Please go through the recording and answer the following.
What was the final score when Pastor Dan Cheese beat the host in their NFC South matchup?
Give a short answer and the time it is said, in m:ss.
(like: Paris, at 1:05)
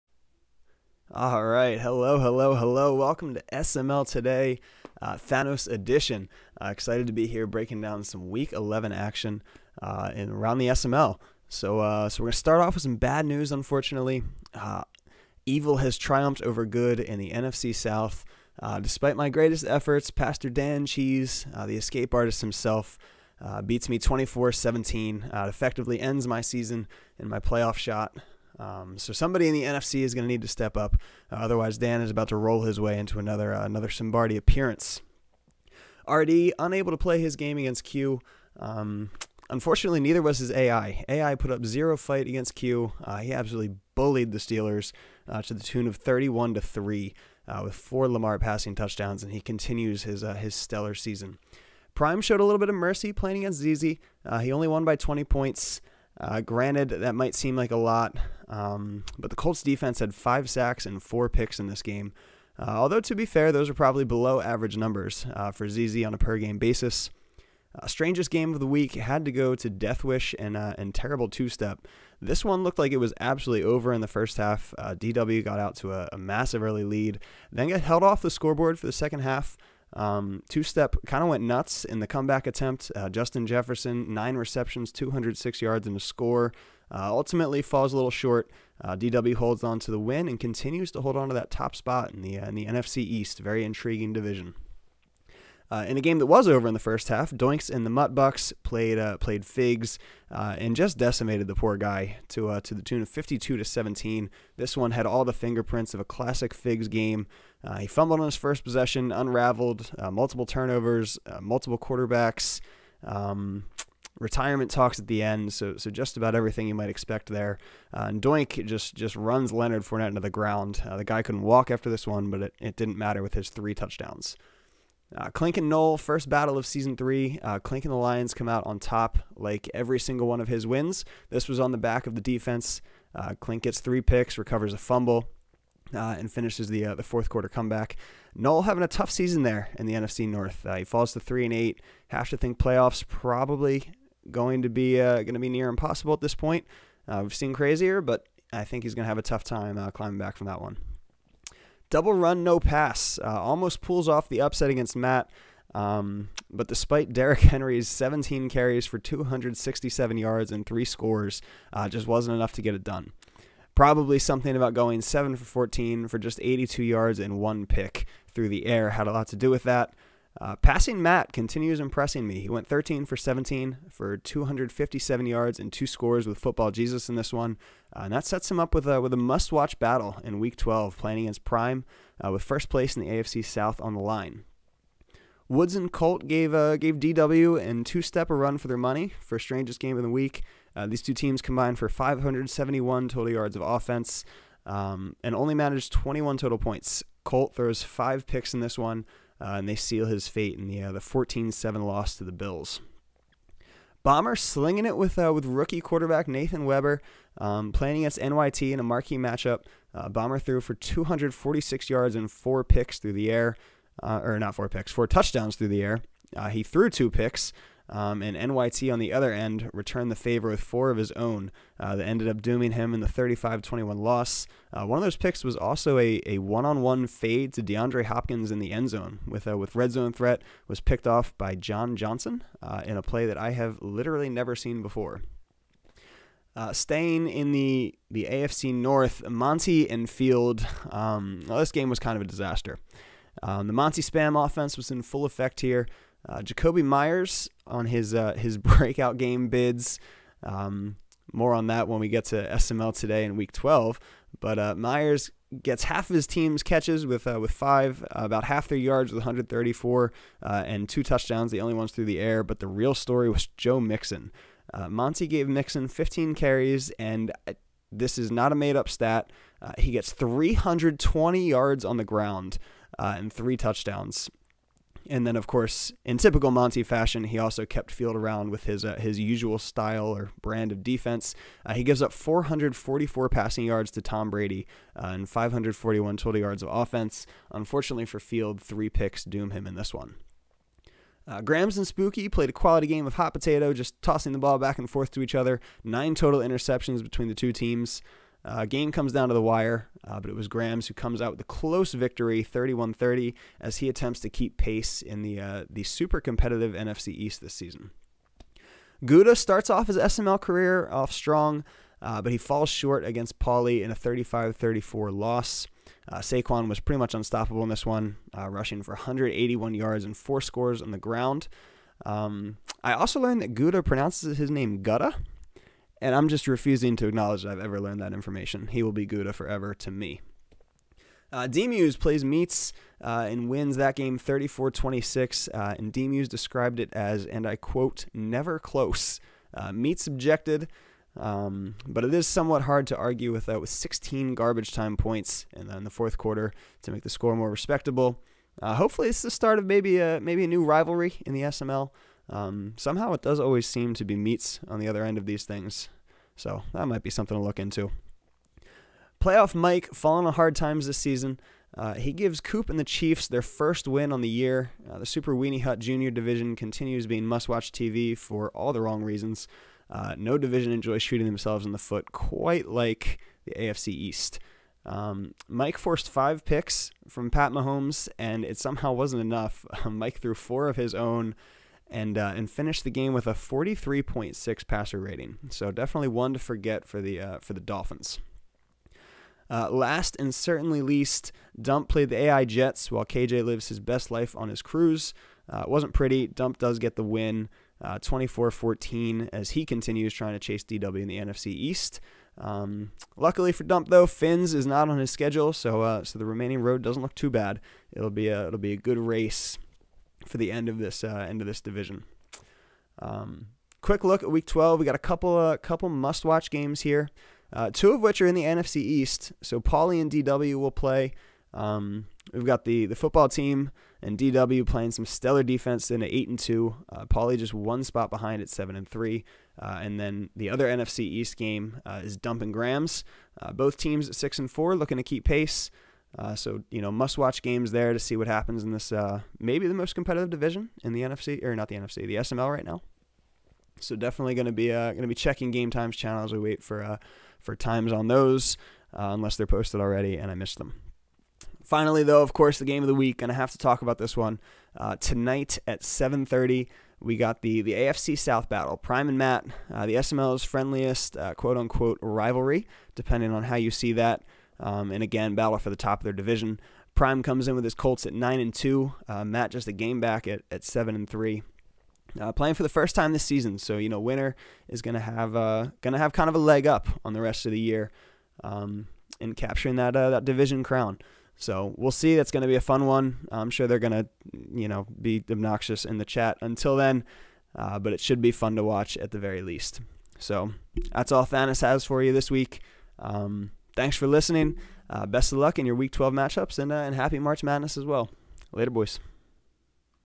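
24-17, at 0:23.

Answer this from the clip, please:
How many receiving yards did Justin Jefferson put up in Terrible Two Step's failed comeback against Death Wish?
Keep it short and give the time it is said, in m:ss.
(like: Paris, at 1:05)
206, at 1:24.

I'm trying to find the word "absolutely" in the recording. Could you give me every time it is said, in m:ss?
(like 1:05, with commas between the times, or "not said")
0:43, 1:13.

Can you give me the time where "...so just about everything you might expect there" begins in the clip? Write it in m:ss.
1:55.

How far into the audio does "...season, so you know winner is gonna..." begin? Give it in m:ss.
7:53.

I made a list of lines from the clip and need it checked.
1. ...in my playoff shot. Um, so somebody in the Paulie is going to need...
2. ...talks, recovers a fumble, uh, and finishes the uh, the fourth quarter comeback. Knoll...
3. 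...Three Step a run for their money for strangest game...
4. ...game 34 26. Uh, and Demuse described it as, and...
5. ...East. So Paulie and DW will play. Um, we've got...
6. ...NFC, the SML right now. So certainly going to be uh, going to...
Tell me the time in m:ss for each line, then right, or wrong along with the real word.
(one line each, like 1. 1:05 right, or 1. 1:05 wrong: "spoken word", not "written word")
1. 0:27 wrong: "NFC", not "Paulie"
2. 2:14 wrong: "picks", not "talks"
3. 3:07 wrong: "Two", not "Three"
4. 5:33 right
5. 6:58 right
6. 7:21 wrong: "definitely", not "certainly".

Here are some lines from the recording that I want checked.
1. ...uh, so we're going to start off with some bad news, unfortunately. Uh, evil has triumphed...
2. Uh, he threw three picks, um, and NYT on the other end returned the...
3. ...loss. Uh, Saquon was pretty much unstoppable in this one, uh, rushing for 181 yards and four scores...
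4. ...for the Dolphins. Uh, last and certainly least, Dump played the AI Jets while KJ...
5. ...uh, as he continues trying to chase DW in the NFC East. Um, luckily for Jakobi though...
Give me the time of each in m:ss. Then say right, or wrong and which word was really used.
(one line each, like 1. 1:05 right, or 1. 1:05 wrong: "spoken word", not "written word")
1. 0:11 right
2. 3:36 wrong: "two", not "three"
3. 5:15 right
4. 6:27 right
5. 6:39 wrong: "Dump", not "Jakobi".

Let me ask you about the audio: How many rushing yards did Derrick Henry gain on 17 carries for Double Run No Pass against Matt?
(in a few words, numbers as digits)
267.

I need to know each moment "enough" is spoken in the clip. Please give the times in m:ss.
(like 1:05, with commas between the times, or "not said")
2:42, 6:19.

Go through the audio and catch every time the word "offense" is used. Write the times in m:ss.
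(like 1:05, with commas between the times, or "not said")
3:13, 4:04, 4:46.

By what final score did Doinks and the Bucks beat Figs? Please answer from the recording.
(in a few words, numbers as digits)
52-17.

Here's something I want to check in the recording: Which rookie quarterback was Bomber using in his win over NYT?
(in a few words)
Nathan Weber.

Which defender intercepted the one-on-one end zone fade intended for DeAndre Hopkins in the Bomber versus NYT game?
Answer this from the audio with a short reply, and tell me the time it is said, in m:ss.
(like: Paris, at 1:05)
John Johnson, at 3:51.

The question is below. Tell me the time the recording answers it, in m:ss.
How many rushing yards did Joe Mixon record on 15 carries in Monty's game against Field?
4:30.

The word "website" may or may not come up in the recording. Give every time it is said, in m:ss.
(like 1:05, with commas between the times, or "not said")
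not said.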